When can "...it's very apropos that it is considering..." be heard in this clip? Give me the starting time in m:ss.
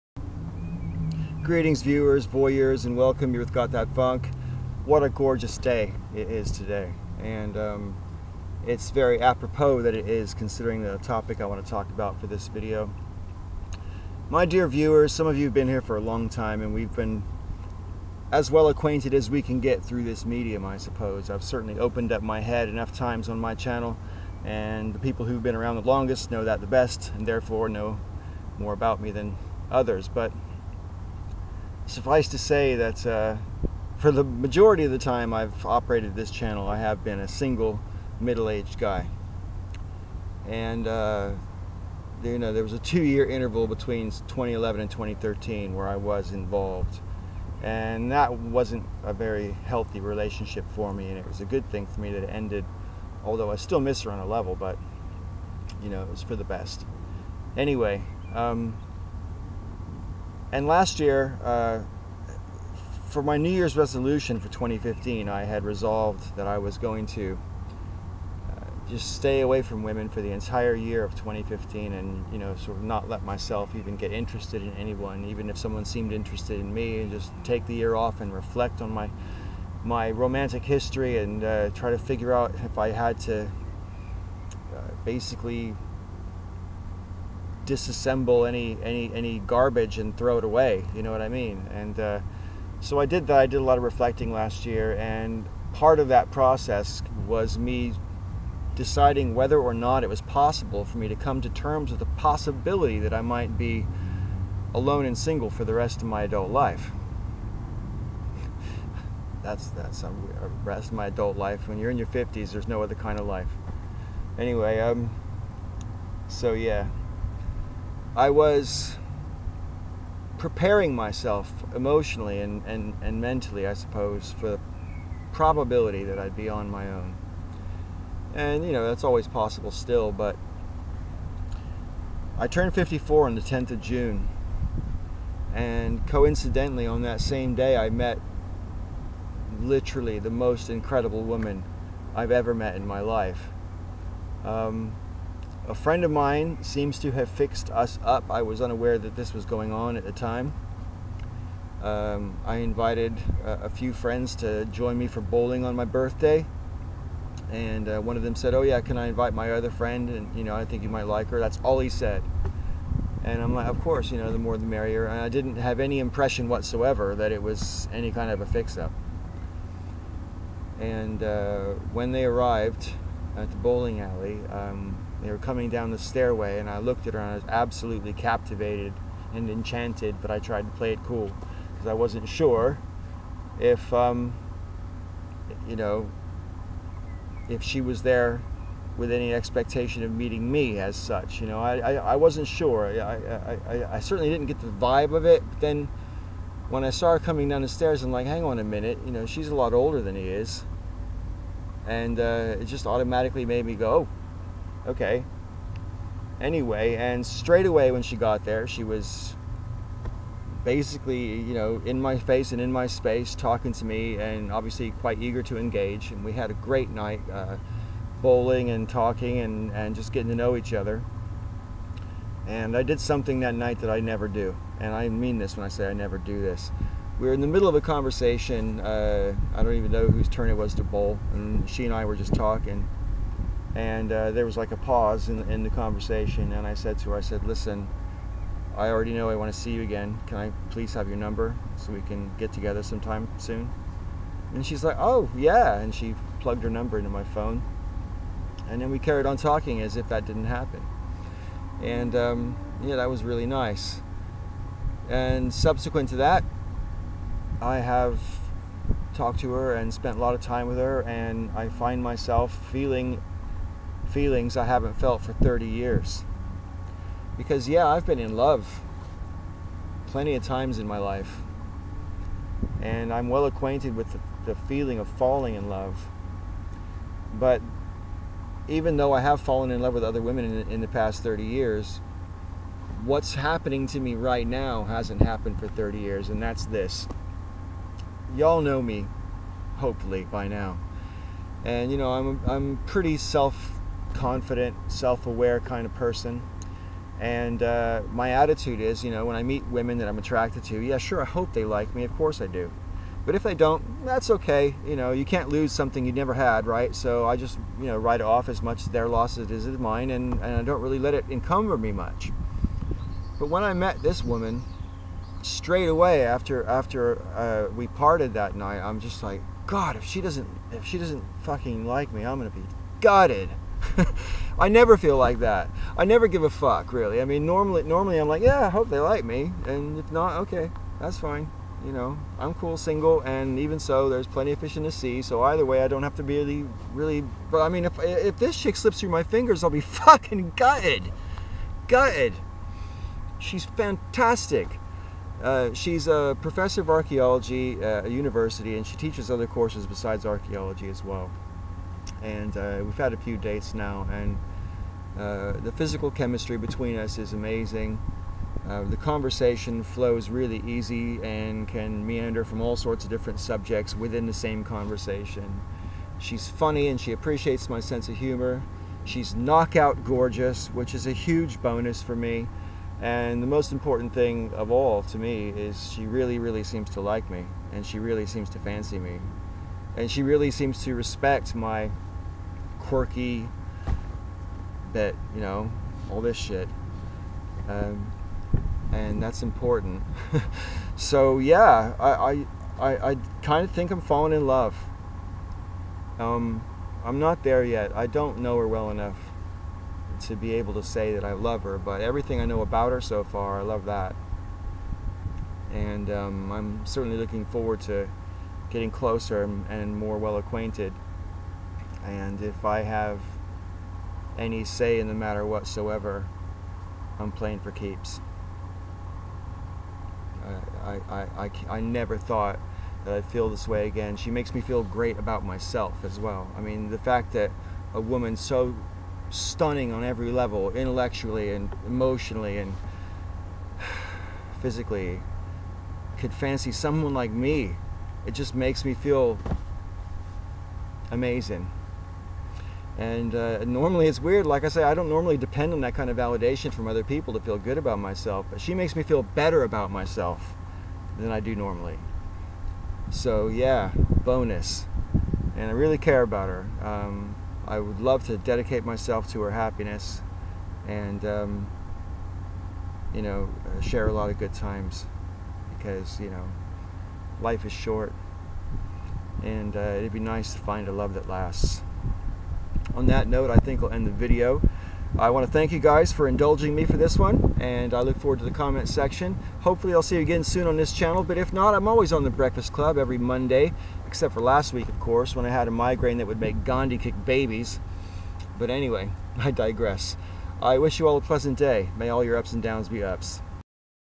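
0:08.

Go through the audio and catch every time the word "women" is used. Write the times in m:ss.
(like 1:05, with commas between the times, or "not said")
1:09, 4:40, 4:59.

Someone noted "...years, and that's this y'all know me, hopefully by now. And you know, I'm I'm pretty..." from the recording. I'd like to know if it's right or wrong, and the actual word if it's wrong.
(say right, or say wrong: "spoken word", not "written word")
right.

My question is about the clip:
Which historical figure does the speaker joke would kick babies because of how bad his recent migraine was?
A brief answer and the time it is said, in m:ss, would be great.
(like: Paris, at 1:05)
Gandhi, at 8:06.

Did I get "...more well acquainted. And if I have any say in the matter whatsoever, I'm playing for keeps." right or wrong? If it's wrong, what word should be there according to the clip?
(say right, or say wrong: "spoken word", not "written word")
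right.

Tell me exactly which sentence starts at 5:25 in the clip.
I never give a fuck, really.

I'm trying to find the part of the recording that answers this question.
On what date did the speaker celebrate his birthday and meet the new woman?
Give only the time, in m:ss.
2:13.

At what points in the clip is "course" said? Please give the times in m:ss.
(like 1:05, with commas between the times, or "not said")
2:43, 5:02, 5:49, 8:05.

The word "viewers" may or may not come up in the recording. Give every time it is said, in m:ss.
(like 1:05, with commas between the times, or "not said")
0:01, 0:14.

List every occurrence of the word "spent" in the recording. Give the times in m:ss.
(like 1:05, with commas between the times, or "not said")
4:19.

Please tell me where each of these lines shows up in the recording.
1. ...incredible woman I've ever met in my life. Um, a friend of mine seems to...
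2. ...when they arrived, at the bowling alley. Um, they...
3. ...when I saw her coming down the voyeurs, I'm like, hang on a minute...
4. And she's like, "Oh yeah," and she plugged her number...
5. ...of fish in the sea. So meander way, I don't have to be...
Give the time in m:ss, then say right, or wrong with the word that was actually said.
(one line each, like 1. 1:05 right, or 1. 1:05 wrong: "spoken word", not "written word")
1. 2:20 right
2. 2:51 right
3. 3:16 wrong: "stairs", not "voyeurs"
4. 4:04 right
5. 5:34 wrong: "either", not "meander".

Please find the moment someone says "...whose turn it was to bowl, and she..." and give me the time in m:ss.
3:50.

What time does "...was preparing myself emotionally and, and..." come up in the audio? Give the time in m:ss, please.
1:58.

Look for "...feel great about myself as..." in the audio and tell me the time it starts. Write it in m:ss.
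7:04.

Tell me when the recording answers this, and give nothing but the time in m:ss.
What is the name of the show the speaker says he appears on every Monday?
8:02.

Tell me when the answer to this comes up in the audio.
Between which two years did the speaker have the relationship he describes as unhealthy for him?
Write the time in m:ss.
0:44.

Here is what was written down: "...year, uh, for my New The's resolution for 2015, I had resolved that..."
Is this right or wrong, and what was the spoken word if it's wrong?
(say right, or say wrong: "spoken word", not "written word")
wrong: "Year", not "The".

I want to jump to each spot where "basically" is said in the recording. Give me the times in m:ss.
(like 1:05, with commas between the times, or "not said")
1:25, 3:30.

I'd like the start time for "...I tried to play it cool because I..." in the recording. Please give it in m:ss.
3:00.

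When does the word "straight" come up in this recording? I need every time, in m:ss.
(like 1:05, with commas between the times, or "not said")
3:27, 5:15.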